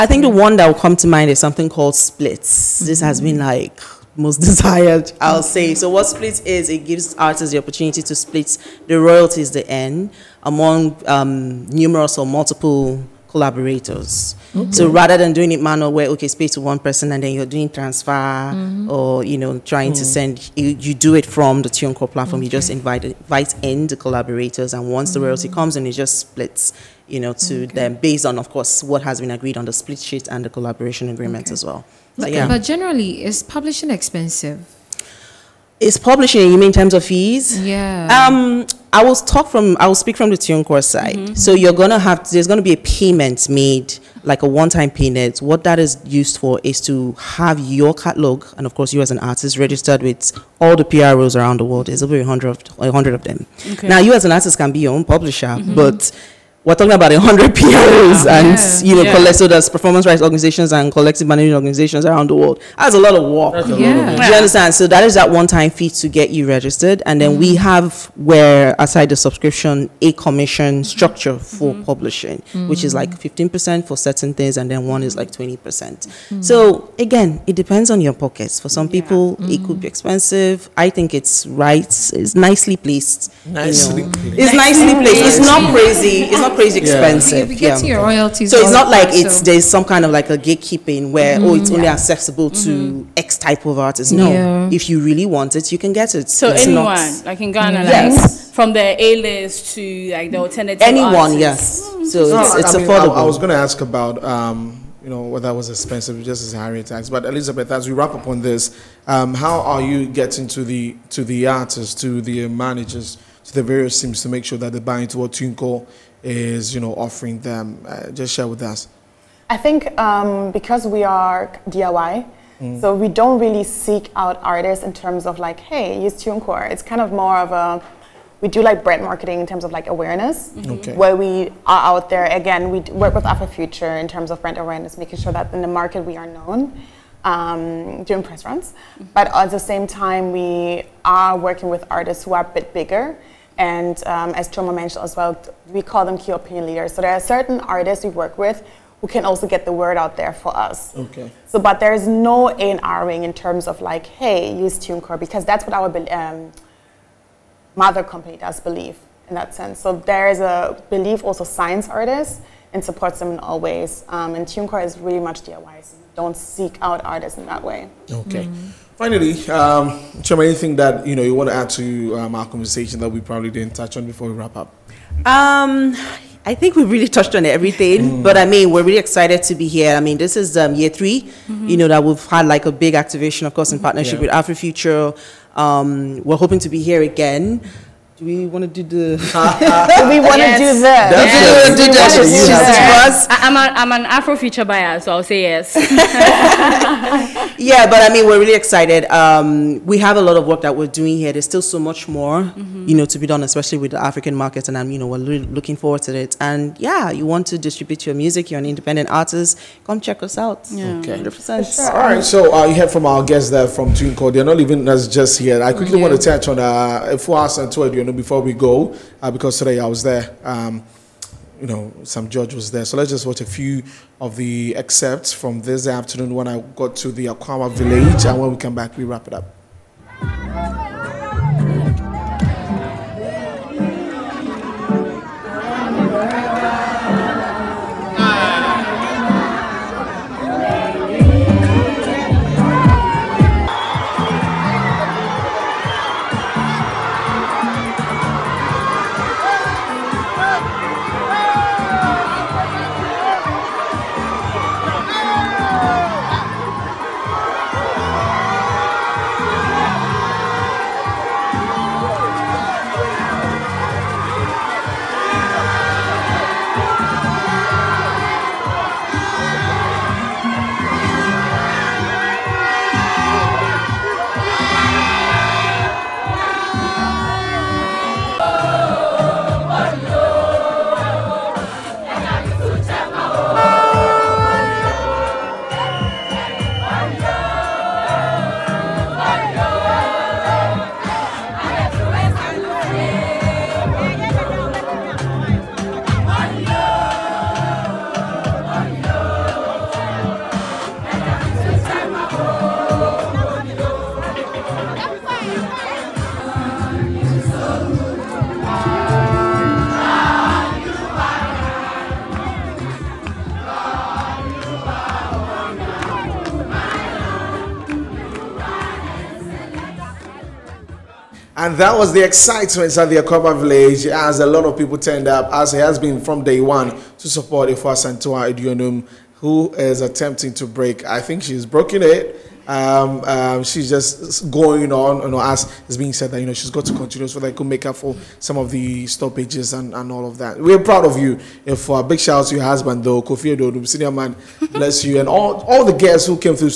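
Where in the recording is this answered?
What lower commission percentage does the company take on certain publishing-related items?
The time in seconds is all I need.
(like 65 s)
73 s.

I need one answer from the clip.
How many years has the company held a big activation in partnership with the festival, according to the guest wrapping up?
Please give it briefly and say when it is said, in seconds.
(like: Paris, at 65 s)
3, at 180 s.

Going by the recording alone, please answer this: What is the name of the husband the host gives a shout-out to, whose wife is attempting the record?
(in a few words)
Kofi Ododum.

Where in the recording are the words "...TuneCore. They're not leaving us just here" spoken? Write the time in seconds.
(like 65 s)
213 s.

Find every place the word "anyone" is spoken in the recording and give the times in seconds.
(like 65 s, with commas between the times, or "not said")
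96 s, 100 s.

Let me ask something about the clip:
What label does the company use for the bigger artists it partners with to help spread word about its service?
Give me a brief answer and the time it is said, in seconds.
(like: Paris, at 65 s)
key opinion leaders, at 146 s.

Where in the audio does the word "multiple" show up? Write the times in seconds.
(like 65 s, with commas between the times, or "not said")
12 s.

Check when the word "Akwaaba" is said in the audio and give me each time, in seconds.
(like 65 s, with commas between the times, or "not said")
227 s, 323 s.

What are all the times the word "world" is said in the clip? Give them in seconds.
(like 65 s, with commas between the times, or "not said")
51 s, 62 s.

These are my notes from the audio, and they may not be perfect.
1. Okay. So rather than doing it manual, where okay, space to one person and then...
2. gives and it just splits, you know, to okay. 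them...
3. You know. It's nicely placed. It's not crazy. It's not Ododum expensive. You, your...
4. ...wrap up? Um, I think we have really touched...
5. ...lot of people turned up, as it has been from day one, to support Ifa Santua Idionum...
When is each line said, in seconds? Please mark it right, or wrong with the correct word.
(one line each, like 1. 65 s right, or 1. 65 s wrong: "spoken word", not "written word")
1. 14 s right
2. 25 s wrong: "comes", not "gives"
3. 84 s wrong: "Crazy", not "Ododum"
4. 174 s right
5. 324 s right.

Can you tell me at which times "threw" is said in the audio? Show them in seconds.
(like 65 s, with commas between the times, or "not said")
not said.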